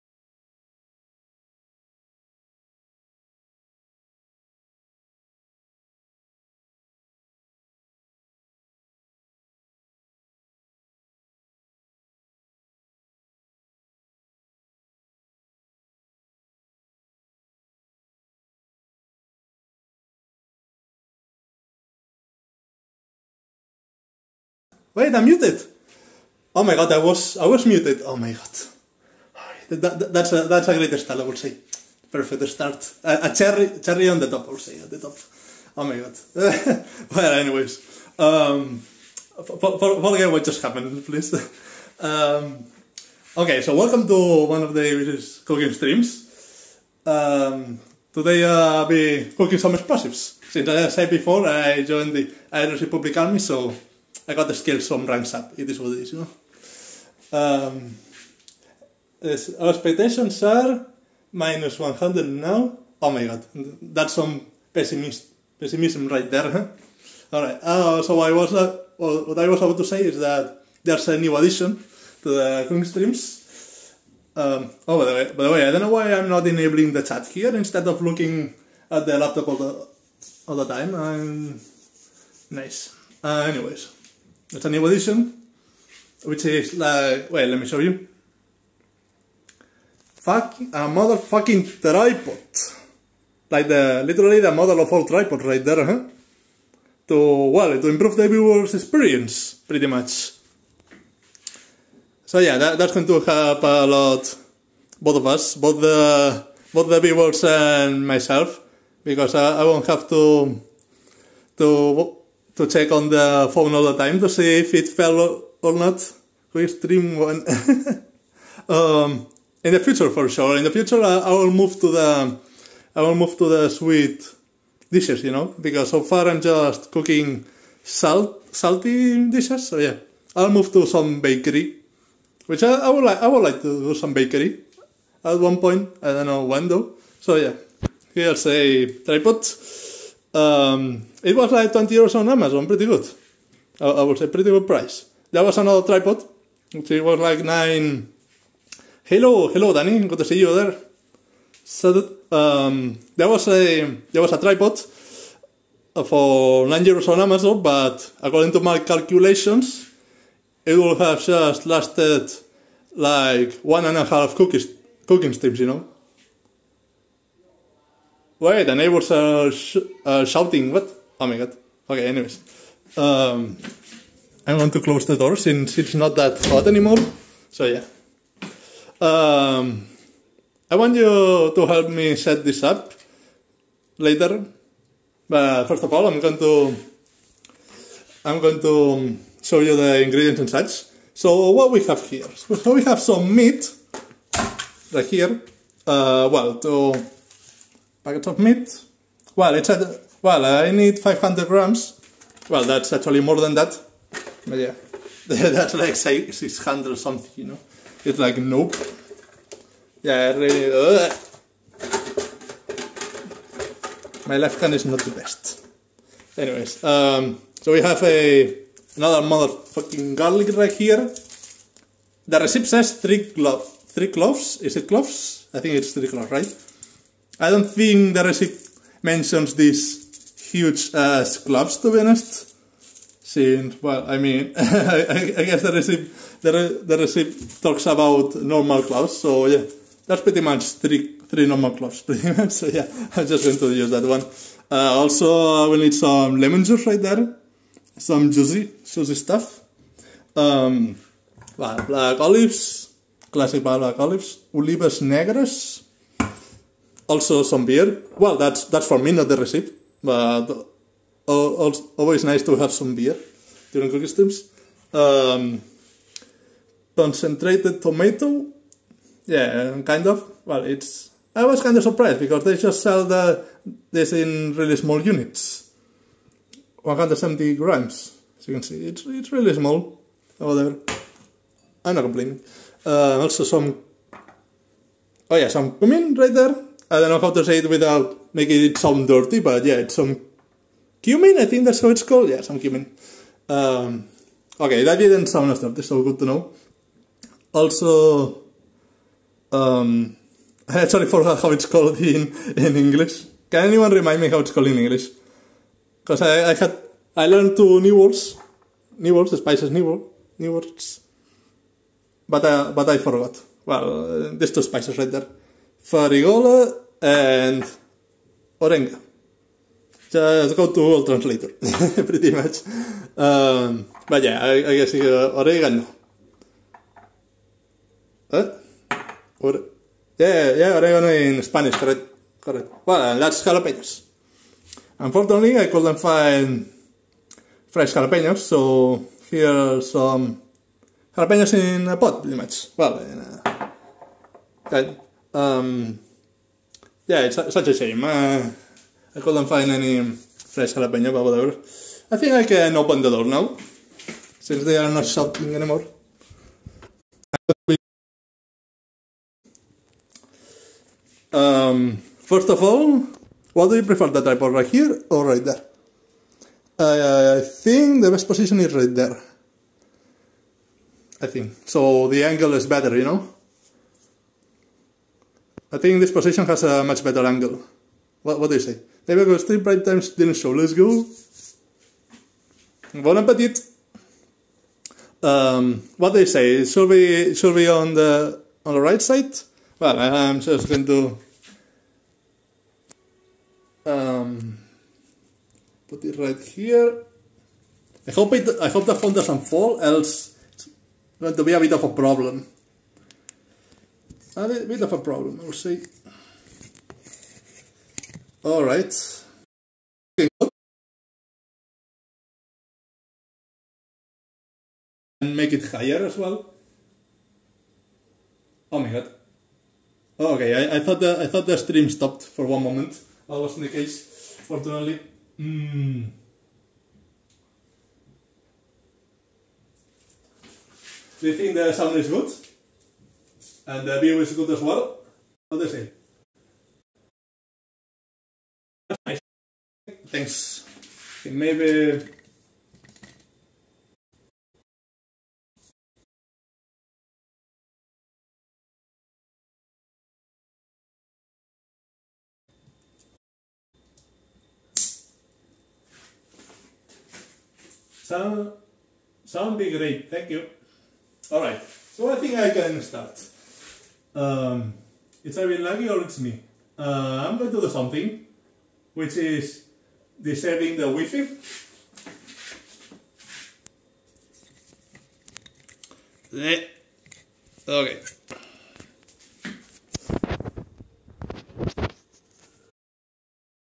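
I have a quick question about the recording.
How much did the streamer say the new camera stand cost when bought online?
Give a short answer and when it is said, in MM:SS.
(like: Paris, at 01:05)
20 euros, at 02:21.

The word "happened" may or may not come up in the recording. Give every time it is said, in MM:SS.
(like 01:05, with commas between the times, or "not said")
00:40.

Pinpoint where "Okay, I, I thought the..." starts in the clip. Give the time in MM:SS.
07:00.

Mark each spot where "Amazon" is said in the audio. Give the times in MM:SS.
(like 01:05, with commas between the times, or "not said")
02:22, 02:37.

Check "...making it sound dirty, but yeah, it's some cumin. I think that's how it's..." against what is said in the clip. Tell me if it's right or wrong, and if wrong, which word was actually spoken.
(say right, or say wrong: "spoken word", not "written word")
right.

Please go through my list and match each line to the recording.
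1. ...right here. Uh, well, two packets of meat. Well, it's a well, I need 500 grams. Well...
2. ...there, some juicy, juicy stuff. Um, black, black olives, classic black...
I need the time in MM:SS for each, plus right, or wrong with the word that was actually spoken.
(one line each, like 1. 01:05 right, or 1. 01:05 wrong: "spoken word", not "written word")
1. 03:14 right
2. 04:07 right.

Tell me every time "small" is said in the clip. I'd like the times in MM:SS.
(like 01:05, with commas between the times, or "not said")
04:34, 04:39.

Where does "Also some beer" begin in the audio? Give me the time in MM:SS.
04:17.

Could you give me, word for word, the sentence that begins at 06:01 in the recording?
Um, first of all, what do you prefer, the tripod right here or right there?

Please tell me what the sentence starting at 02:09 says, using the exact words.
So yeah, I'll move to some bakery, which I, I would like.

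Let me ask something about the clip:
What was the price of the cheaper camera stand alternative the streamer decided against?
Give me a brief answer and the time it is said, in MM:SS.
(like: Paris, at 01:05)
9 euros, at 02:36.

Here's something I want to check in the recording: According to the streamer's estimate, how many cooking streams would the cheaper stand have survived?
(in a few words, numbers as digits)
one and a half.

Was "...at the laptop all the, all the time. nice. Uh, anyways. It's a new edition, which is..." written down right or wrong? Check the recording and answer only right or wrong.
right.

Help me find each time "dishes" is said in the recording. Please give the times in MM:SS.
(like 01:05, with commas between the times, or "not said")
02:04, 02:09.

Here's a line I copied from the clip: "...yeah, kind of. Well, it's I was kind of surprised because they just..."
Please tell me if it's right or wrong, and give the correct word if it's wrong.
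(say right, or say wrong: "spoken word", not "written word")
right.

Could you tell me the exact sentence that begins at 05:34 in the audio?
Unfortunately, I couldn't find fresh jalapenos, so here are some jalapenos in a pot, pretty much.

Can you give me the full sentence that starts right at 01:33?
Like the, literally the model of all tripods right there, huh?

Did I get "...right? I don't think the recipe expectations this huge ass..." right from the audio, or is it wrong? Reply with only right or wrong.
wrong.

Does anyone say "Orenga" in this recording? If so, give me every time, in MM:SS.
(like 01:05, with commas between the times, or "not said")
05:18, 05:25.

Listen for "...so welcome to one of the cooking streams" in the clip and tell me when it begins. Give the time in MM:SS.
00:43.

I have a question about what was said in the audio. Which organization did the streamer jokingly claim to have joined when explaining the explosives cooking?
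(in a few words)
Irish Republic Army.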